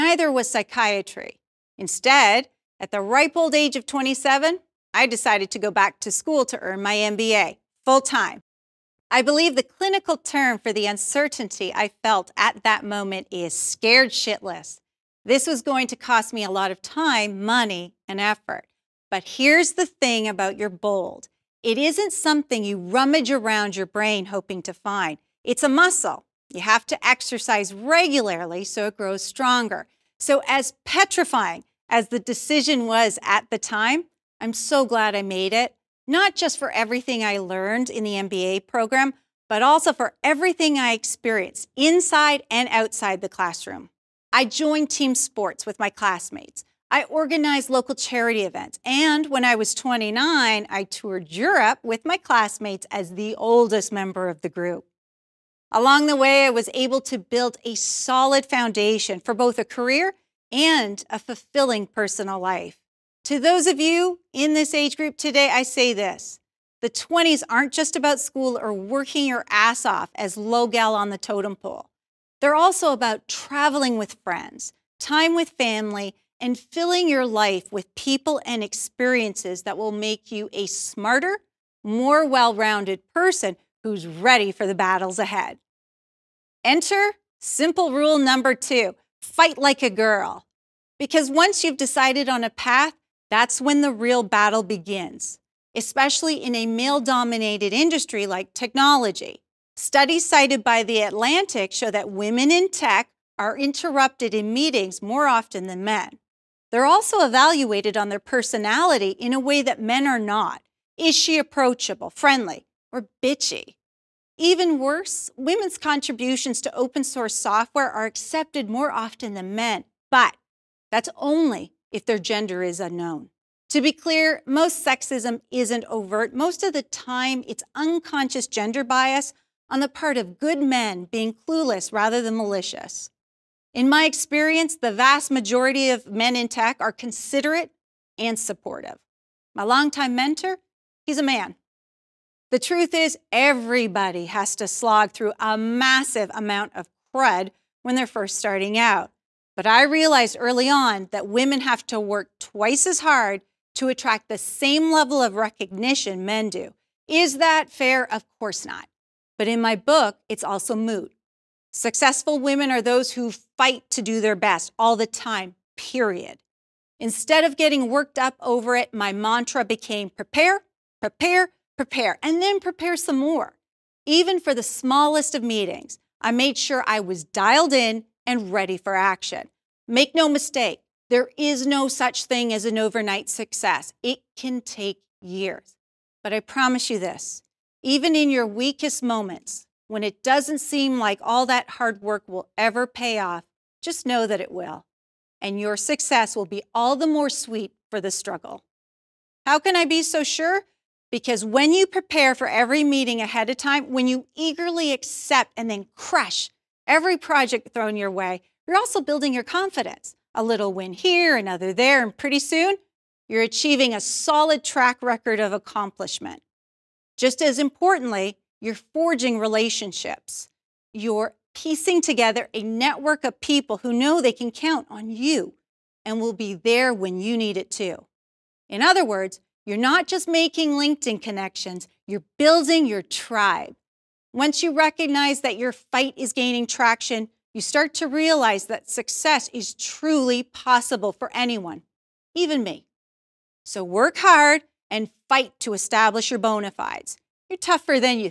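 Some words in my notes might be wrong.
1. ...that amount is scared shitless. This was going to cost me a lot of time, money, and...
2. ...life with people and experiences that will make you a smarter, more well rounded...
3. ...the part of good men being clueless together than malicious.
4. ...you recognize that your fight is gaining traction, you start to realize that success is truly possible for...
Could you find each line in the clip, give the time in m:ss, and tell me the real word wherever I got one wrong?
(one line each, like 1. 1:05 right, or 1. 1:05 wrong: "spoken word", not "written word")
1. 0:12 wrong: "moment", not "amount"
2. 1:17 right
3. 2:09 wrong: "rather", not "together"
4. 3:54 right.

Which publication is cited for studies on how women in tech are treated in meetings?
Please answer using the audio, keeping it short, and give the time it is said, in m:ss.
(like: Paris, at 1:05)
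The Atlantic, at 1:40.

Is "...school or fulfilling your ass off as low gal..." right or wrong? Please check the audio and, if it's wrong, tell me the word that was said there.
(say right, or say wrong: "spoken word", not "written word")
wrong: "working", not "fulfilling".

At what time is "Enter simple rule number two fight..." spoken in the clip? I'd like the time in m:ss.
1:26.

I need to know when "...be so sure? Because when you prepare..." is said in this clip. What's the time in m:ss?
3:19.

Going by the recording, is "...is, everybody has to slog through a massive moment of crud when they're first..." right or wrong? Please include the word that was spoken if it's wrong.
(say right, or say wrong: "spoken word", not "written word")
wrong: "amount", not "moment".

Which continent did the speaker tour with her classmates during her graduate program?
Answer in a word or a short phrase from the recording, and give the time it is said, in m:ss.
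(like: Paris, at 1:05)
Europe, at 0:51.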